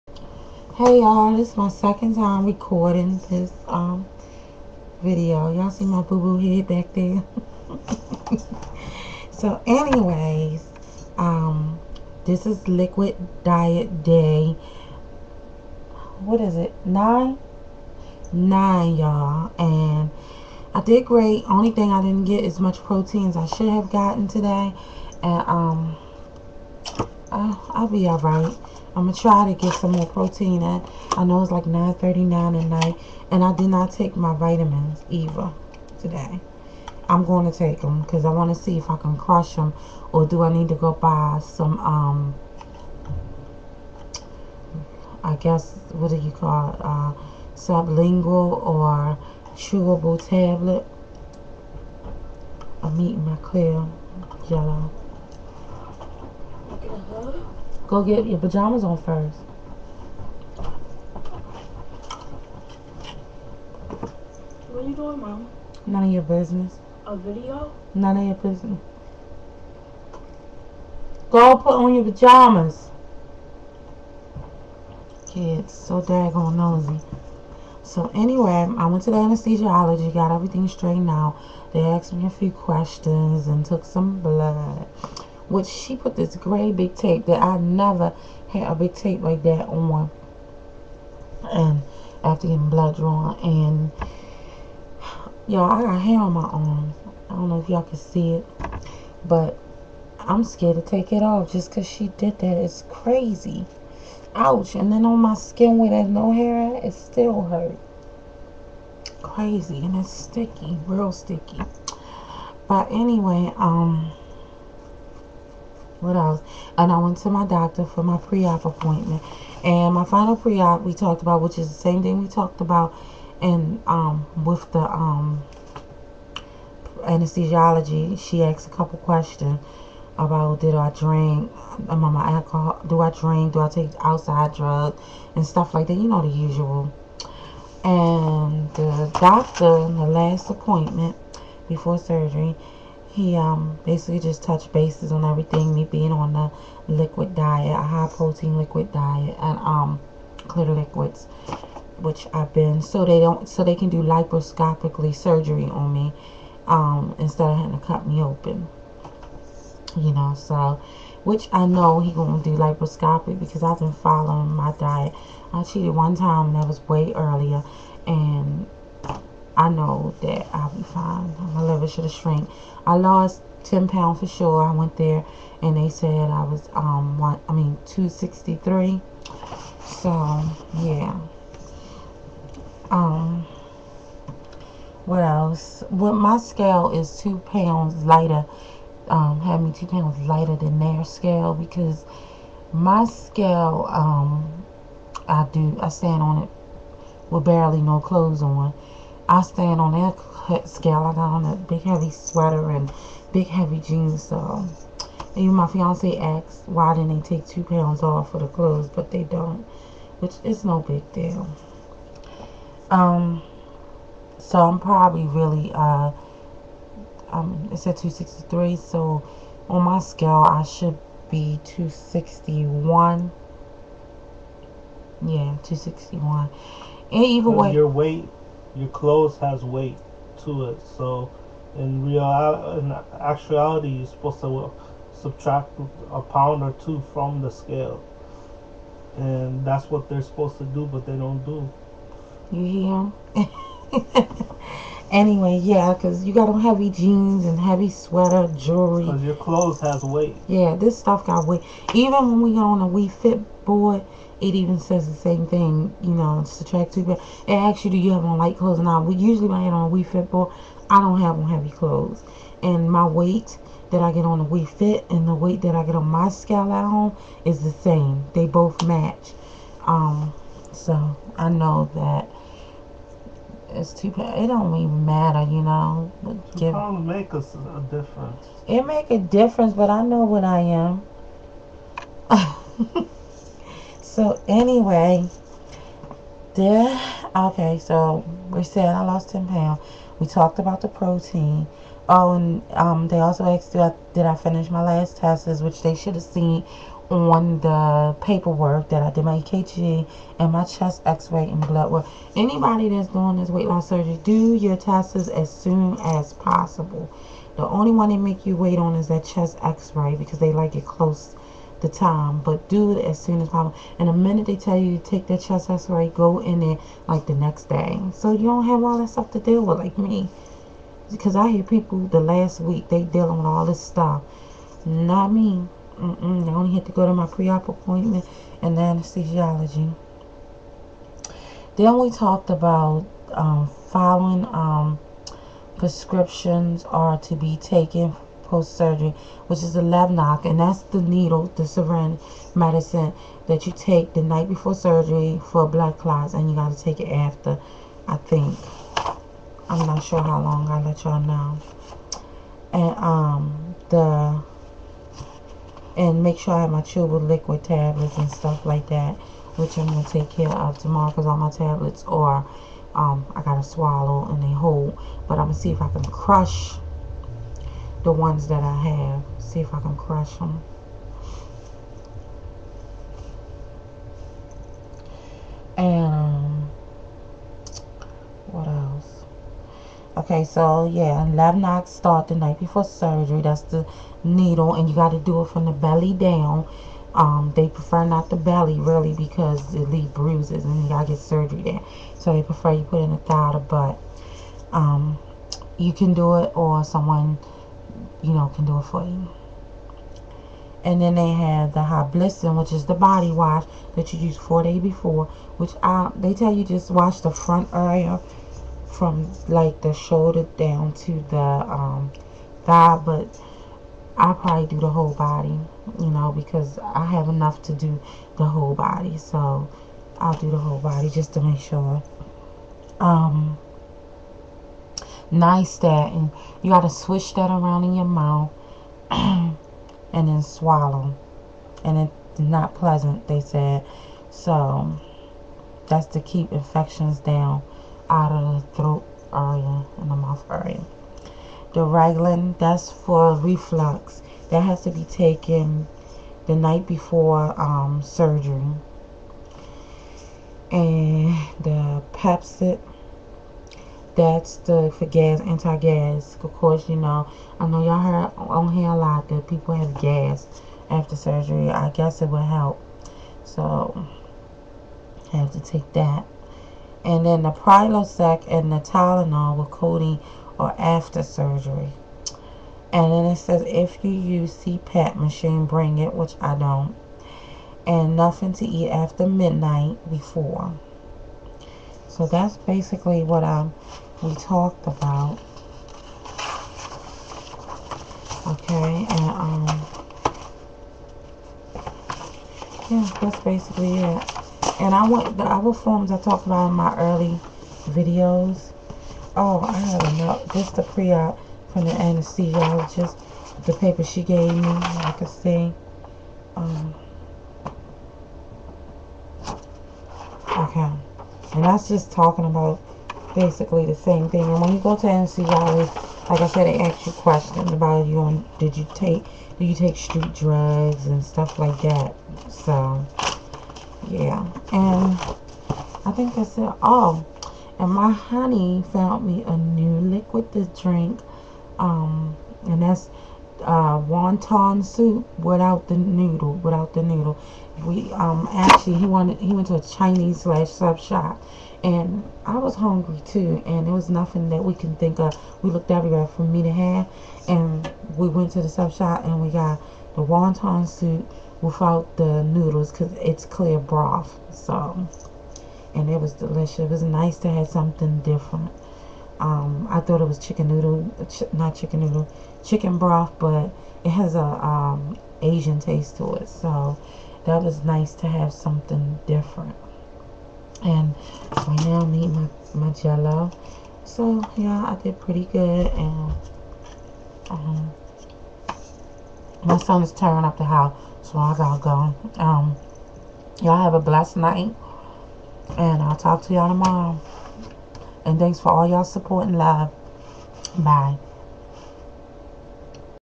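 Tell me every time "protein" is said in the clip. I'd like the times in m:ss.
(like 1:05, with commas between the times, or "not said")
0:22, 0:30, 2:28, 4:50.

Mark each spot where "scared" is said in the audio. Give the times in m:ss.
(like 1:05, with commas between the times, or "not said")
1:40.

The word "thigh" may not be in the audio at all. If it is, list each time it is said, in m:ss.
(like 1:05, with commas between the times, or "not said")
6:33, 6:52.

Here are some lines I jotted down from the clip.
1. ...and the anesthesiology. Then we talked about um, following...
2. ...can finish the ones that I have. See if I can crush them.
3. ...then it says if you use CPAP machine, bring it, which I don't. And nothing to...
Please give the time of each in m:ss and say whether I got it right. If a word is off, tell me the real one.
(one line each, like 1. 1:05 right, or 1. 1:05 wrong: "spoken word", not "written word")
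1. 5:28 right
2. 6:05 wrong: "crush", not "finish"
3. 7:53 right.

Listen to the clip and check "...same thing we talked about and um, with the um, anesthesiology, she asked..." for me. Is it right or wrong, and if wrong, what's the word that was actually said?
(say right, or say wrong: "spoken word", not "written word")
right.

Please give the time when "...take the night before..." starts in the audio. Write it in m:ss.
5:43.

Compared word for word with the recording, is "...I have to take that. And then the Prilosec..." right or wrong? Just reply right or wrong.
right.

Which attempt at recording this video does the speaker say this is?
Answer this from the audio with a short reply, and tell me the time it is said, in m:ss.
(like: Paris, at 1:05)
second, at 0:01.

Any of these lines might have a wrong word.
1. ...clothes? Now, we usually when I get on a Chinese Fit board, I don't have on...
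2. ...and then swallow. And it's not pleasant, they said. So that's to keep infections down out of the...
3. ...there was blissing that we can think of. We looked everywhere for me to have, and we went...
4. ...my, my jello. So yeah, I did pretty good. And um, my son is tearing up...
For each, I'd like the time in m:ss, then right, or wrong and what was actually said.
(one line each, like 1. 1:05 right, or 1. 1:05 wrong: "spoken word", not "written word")
1. 4:18 wrong: "Wii", not "Chinese"
2. 7:09 right
3. 9:03 wrong: "nothing", not "blissing"
4. 9:32 right.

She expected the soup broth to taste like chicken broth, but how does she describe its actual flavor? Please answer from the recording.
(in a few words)
Asian taste.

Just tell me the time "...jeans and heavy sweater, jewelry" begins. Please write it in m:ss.
4:06.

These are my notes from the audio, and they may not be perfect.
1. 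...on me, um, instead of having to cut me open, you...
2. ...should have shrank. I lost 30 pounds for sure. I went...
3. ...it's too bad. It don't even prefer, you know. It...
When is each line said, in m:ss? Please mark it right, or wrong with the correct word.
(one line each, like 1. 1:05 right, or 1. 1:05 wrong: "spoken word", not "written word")
1. 2:35 right
2. 2:51 wrong: "10", not "30"
3. 4:33 wrong: "matter", not "prefer".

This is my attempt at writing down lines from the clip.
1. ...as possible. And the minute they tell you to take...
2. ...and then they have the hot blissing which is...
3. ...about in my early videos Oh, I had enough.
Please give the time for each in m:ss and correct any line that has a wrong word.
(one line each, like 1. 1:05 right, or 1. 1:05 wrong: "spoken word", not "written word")
1. 5:13 right
2. 6:40 right
3. 8:16 right.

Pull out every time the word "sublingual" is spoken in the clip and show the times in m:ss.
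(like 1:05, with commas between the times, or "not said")
0:47.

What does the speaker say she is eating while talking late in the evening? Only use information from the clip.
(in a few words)
clear yellow.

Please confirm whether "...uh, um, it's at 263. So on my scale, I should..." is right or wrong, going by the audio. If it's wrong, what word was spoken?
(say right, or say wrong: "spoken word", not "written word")
right.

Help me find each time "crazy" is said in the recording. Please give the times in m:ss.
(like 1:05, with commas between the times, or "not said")
1:42, 1:49.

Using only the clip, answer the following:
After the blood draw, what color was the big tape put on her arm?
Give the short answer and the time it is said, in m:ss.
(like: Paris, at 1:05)
gray, at 1:26.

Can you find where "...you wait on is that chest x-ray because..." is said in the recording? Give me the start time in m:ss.
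5:08.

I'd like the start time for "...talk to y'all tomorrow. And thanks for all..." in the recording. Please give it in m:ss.
9:46.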